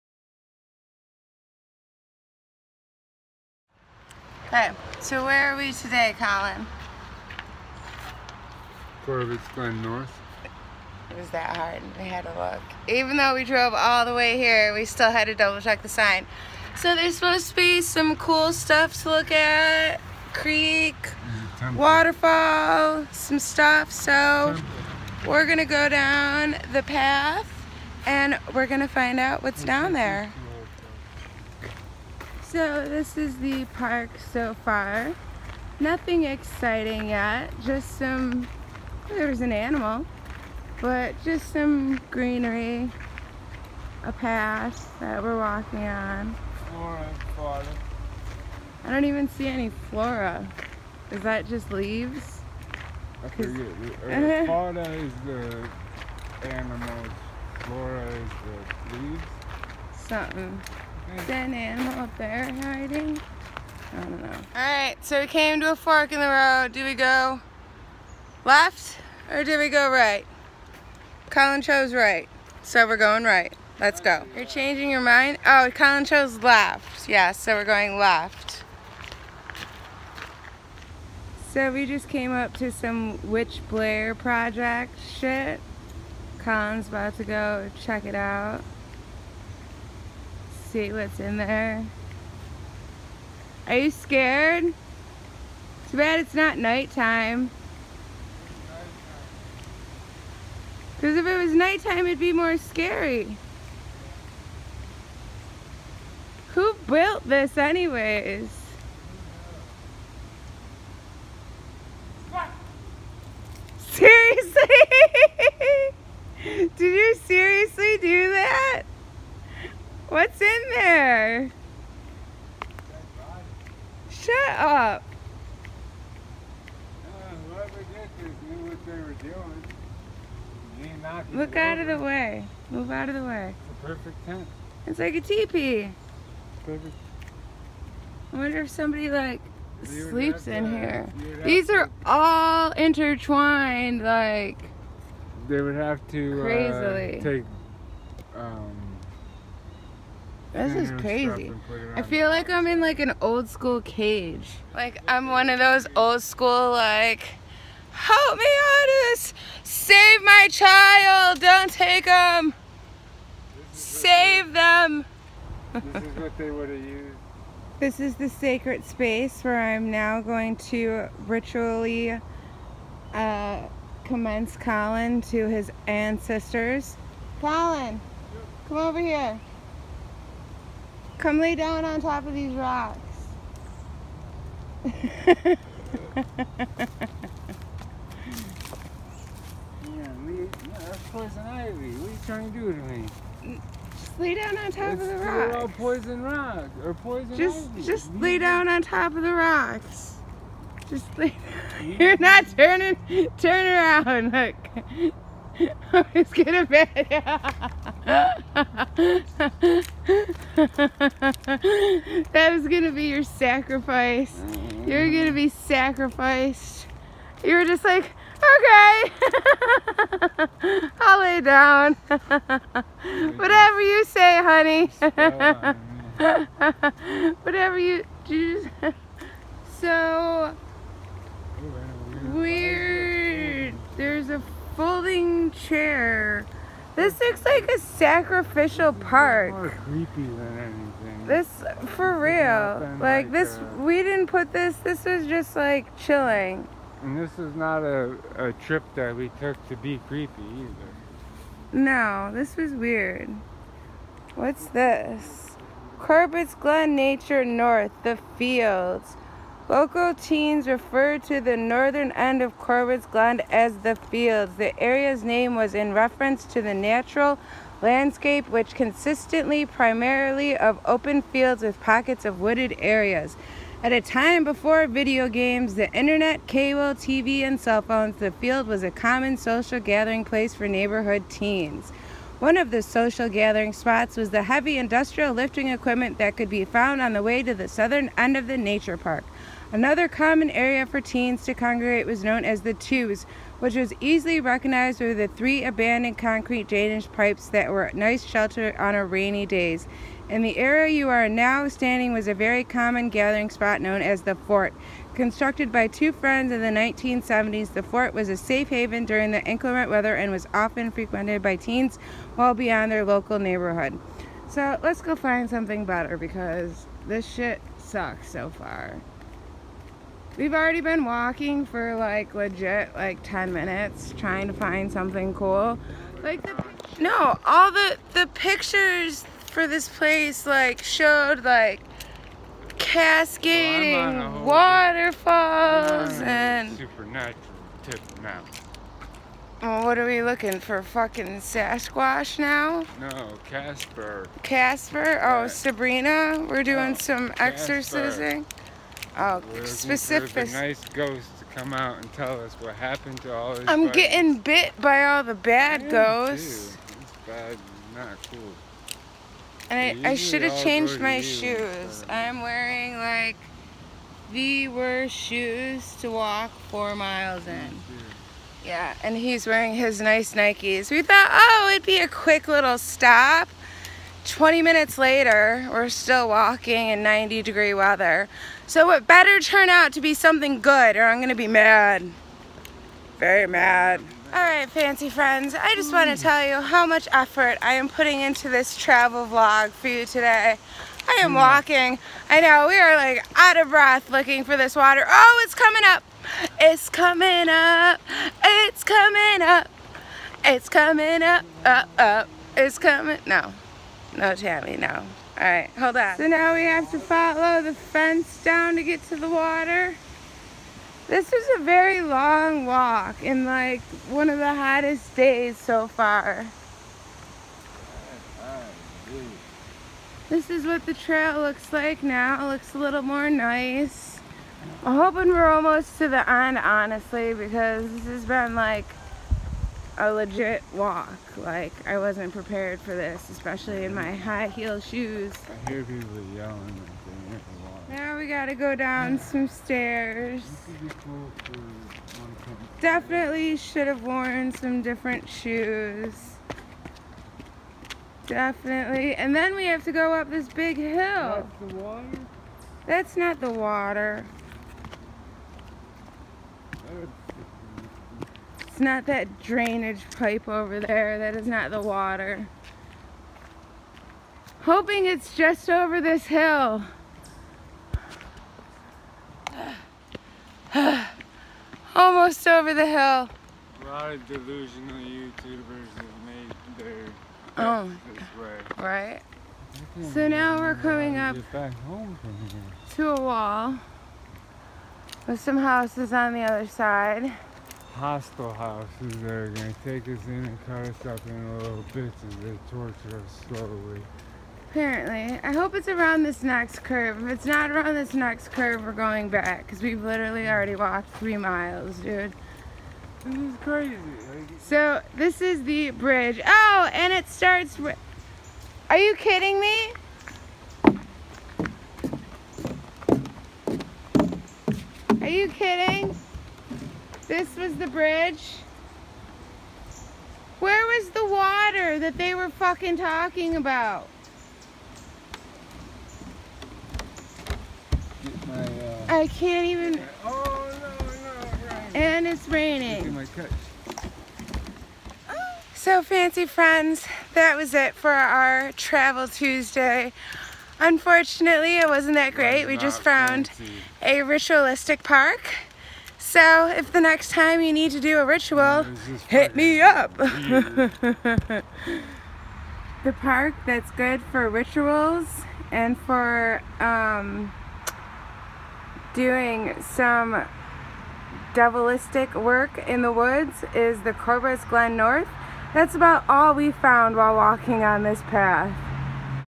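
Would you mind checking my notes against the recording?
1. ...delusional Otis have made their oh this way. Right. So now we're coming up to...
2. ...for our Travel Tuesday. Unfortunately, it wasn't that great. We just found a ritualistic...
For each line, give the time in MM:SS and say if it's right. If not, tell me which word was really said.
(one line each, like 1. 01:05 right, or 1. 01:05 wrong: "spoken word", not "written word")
1. 07:54 wrong: "YouTubers", not "Otis"
2. 08:57 right.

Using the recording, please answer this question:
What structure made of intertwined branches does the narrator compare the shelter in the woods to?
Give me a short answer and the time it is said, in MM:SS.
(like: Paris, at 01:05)
A teepee, at 02:14.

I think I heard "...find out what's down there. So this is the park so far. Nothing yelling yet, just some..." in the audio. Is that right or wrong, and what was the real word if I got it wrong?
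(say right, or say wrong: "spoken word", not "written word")
wrong: "exciting", not "yelling".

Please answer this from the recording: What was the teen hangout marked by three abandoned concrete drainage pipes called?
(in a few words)
The tubes.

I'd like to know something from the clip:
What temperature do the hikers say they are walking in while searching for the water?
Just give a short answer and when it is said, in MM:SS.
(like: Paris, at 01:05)
90 degrees, at 06:17.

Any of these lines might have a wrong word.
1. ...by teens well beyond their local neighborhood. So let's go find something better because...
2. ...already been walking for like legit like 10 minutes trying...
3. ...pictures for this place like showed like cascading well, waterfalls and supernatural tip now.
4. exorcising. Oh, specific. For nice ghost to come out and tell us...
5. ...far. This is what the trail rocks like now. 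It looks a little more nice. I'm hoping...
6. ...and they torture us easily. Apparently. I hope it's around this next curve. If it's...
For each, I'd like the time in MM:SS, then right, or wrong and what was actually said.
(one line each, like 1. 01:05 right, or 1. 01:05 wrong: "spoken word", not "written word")
1. 05:11 right
2. 05:20 right
3. 05:28 right
4. 05:47 right
5. 06:55 wrong: "looks", not "rocks"
6. 08:12 wrong: "slowly", not "easily".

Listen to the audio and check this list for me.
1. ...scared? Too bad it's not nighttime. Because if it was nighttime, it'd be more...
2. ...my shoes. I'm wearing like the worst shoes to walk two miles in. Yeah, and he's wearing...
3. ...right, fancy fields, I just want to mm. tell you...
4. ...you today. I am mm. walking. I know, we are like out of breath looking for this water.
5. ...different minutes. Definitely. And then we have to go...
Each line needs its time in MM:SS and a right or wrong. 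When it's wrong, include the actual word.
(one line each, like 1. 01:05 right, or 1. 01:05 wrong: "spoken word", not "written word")
1. 01:33 right
2. 06:00 wrong: "four", not "two"
3. 06:24 wrong: "friends", not "fields"
4. 06:29 right
5. 07:24 wrong: "shoes", not "minutes".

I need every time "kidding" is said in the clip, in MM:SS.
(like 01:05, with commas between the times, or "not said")
08:29, 08:35.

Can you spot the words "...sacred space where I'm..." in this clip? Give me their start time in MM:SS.
02:48.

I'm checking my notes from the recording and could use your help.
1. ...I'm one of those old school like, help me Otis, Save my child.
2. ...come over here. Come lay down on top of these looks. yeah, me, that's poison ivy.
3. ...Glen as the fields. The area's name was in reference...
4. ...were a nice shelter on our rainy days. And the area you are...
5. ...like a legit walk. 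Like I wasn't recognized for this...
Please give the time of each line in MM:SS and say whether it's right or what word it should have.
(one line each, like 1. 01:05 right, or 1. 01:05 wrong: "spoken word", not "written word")
1. 02:35 right
2. 02:58 wrong: "rocks", not "looks"
3. 04:23 right
4. 04:57 right
5. 07:08 wrong: "prepared", not "recognized".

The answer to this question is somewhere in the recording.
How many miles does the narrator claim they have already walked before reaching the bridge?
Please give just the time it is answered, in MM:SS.
08:21.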